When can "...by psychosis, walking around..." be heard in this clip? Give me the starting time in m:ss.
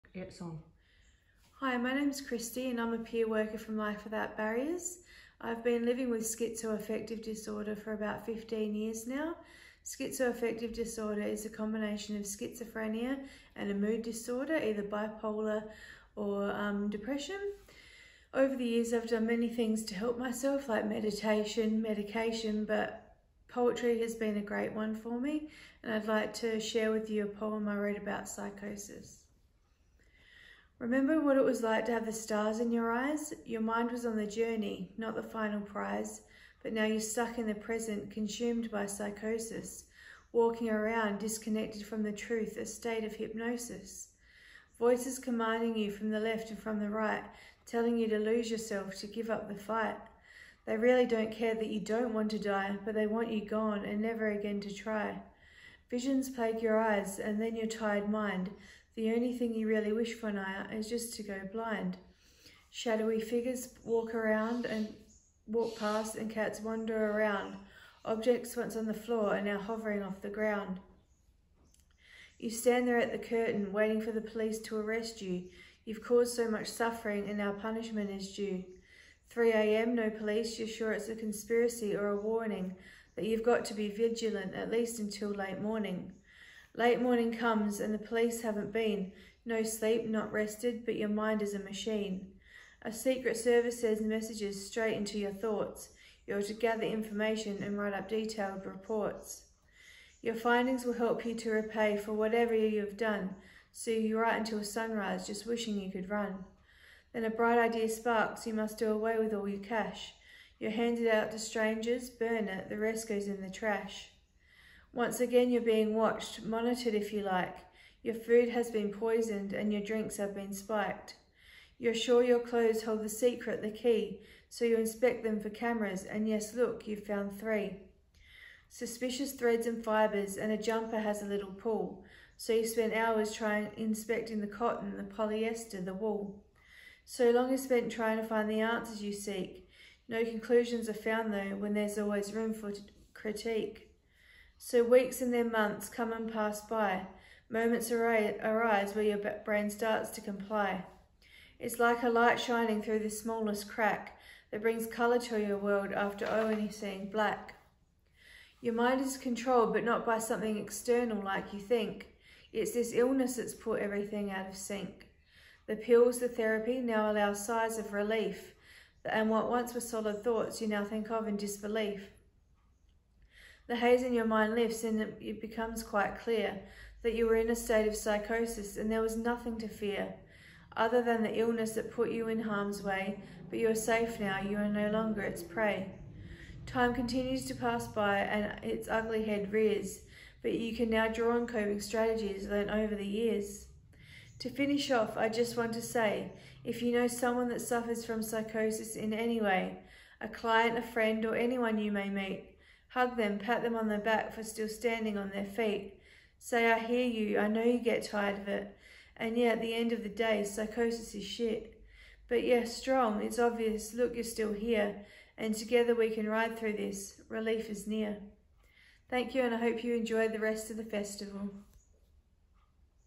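0:38.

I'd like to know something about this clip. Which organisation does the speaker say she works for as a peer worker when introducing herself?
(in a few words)
Life Without Barriers.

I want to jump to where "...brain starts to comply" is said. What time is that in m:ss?
2:29.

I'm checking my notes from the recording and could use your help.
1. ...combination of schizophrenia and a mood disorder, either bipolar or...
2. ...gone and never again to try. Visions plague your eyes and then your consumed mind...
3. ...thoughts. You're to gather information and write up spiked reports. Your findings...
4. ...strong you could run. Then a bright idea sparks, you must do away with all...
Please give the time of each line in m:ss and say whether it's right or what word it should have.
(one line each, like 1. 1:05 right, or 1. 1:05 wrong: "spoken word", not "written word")
1. 0:11 right
2. 0:53 wrong: "tired", not "consumed"
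3. 1:35 wrong: "detailed", not "spiked"
4. 1:45 wrong: "wishing", not "strong".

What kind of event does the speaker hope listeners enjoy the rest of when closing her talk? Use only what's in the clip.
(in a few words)
festival.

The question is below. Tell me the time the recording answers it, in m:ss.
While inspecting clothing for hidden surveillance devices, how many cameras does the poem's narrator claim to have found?
2:07.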